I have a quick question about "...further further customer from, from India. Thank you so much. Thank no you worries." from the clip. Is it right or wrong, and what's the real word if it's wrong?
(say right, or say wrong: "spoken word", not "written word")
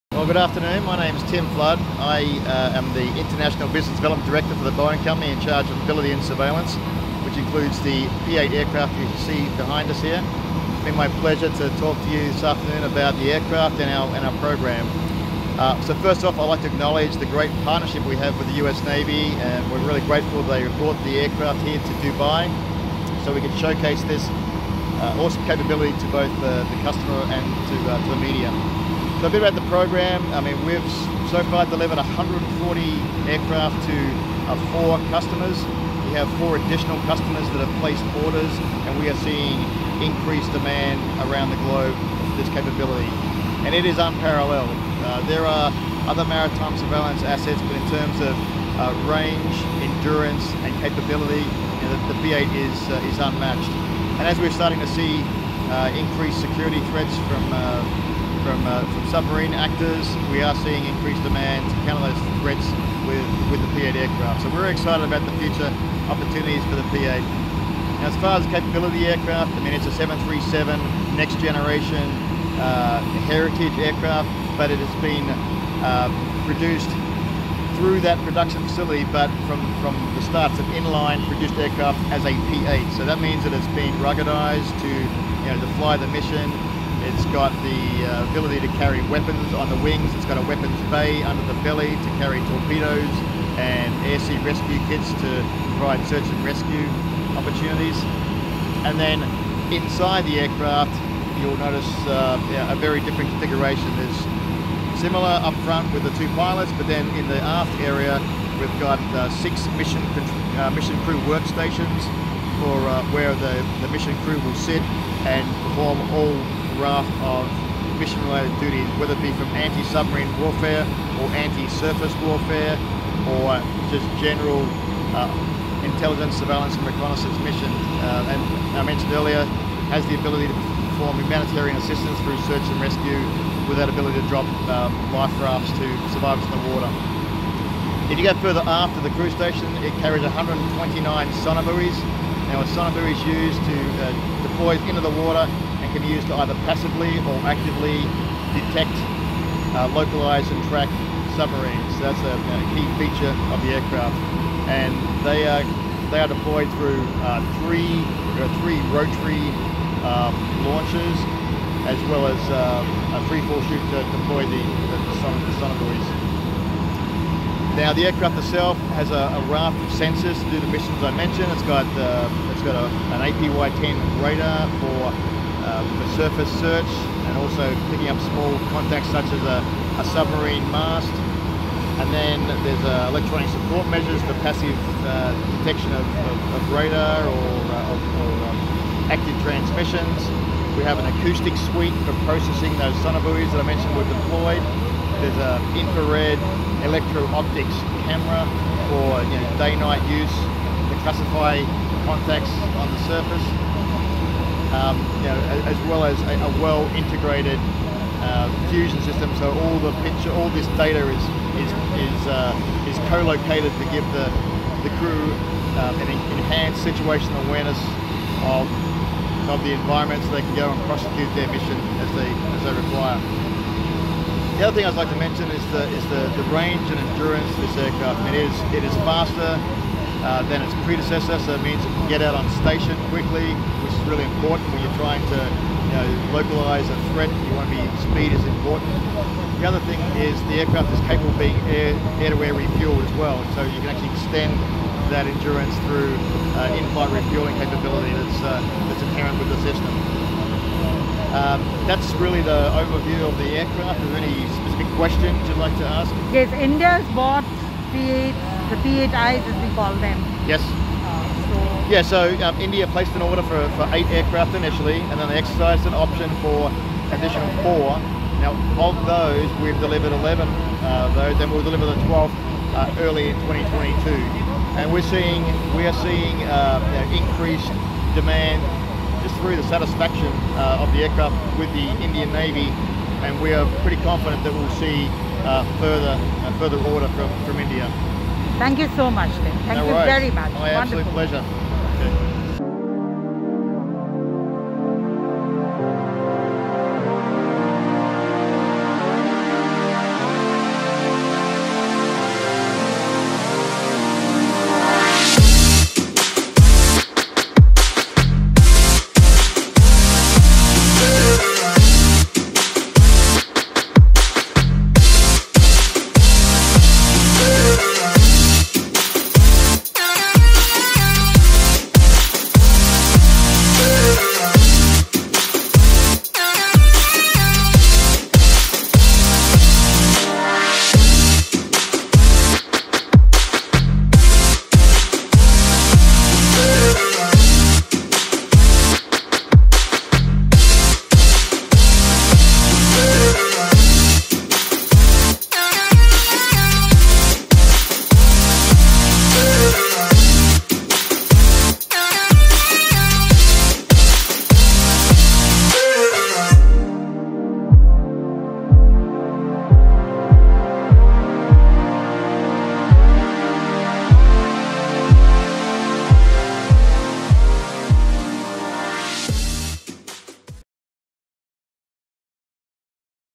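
wrong: "order", not "customer".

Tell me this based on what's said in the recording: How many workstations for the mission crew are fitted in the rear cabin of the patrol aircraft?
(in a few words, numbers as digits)
6.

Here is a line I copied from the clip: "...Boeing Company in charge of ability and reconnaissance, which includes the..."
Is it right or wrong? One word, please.
wrong.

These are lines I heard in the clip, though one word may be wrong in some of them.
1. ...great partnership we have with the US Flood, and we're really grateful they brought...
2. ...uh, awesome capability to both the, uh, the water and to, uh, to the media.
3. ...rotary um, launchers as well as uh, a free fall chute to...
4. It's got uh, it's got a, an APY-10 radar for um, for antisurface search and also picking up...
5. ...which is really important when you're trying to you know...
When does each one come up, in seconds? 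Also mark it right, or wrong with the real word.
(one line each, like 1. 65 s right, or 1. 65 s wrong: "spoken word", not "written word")
1. 17 s wrong: "Navy", not "Flood"
2. 25 s wrong: "customer", not "water"
3. 158 s right
4. 171 s wrong: "surface", not "antisurface"
5. 233 s right.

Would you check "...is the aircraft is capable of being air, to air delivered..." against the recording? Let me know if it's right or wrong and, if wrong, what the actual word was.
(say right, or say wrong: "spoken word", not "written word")
wrong: "refueled", not "delivered".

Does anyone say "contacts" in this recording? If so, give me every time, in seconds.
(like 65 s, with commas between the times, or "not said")
178 s, 202 s.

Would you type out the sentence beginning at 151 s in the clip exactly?
That's a, a, key feature of the aircraft.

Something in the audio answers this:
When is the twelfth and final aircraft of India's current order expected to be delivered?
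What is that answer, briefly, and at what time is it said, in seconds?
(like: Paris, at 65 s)
early 2022, at 273 s.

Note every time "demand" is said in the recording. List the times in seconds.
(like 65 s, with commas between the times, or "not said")
40 s, 61 s, 278 s.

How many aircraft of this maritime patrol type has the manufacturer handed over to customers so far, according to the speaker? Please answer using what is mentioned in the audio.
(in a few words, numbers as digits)
140.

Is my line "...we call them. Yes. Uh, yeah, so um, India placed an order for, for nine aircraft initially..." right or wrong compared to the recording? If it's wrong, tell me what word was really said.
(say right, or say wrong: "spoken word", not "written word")
wrong: "eight", not "nine".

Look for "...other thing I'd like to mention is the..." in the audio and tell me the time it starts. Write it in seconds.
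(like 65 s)
224 s.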